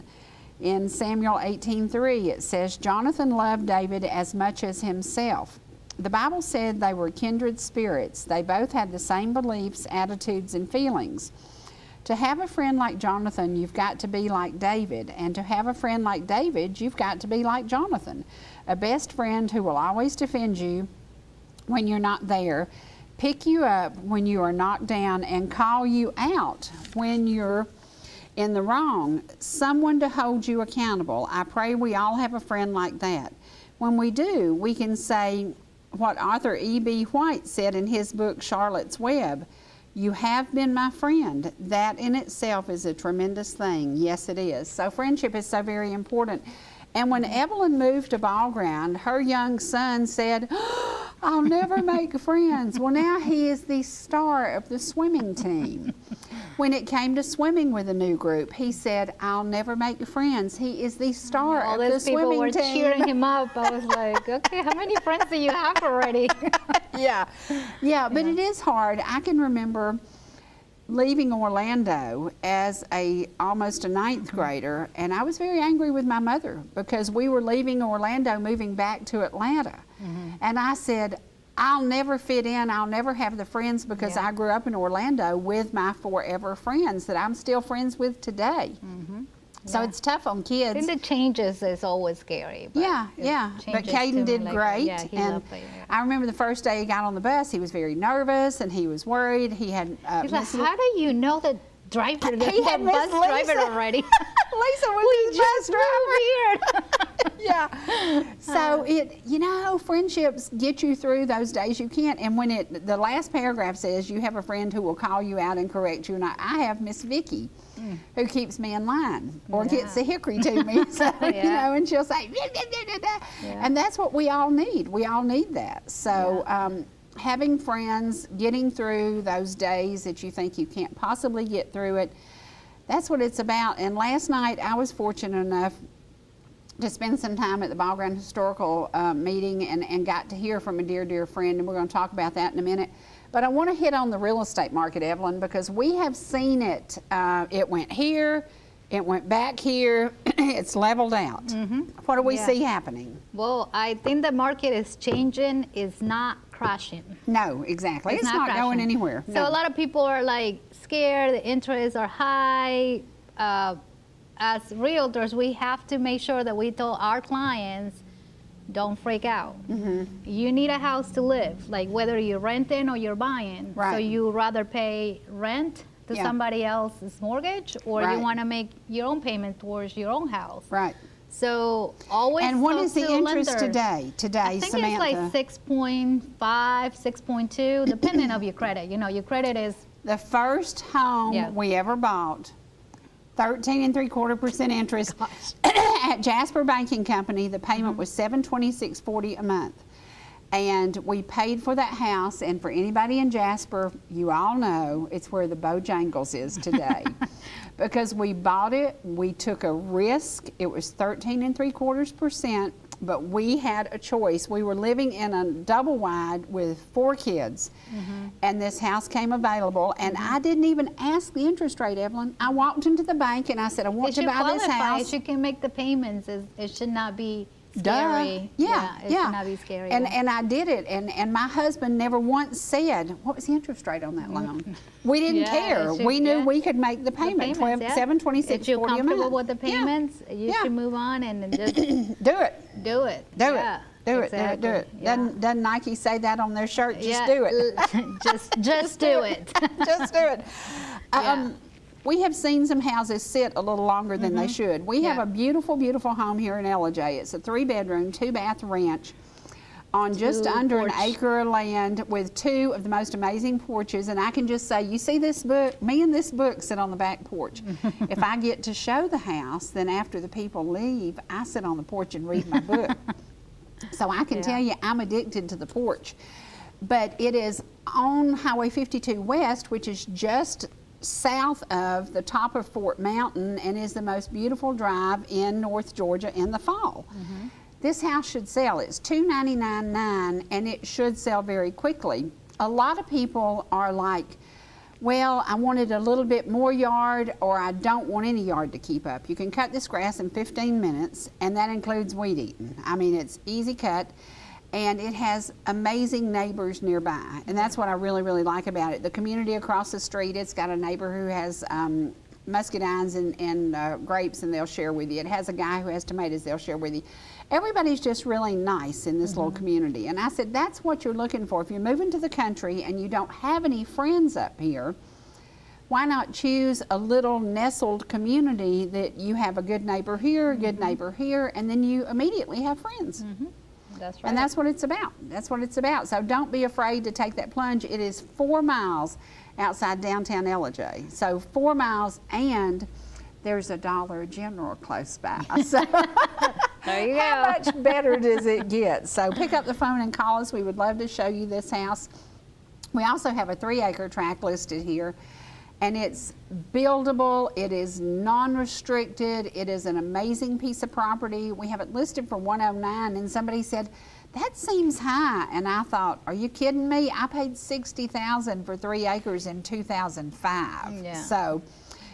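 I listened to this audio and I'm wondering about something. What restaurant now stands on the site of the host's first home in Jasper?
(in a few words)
Bojangles.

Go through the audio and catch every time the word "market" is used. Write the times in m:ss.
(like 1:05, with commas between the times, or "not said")
2:24, 2:34.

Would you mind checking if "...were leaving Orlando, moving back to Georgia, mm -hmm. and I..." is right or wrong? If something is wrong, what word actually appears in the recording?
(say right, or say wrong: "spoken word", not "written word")
wrong: "Atlanta", not "Georgia".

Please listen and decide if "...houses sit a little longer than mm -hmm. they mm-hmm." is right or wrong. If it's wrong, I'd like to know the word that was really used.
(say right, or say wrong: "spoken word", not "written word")
right.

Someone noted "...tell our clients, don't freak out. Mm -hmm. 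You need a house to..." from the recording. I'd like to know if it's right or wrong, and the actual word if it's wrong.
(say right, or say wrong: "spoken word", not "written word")
right.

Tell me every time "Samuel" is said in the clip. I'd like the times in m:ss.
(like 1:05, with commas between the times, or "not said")
0:00.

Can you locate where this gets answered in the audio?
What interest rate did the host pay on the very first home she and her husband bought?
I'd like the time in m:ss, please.
3:13.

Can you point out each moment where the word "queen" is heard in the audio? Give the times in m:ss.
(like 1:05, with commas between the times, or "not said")
not said.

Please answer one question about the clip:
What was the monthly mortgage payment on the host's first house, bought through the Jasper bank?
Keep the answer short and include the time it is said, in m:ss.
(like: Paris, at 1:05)
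$726.40, at 3:18.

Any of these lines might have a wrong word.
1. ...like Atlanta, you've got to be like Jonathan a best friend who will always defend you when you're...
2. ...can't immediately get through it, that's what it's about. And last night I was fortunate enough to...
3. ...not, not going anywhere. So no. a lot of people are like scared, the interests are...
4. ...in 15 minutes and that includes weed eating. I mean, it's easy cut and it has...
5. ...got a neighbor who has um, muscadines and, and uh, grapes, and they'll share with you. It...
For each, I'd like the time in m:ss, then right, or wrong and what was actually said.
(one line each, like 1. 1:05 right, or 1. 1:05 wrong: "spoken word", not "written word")
1. 0:16 wrong: "David", not "Atlanta"
2. 2:10 wrong: "possibly", not "immediately"
3. 2:38 right
4. 5:00 right
5. 5:10 right.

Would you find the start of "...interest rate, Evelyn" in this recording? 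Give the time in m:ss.
3:41.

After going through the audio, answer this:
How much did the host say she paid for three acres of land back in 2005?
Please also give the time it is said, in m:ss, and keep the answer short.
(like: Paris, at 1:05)
$60,000, at 6:07.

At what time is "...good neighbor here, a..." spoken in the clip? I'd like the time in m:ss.
5:29.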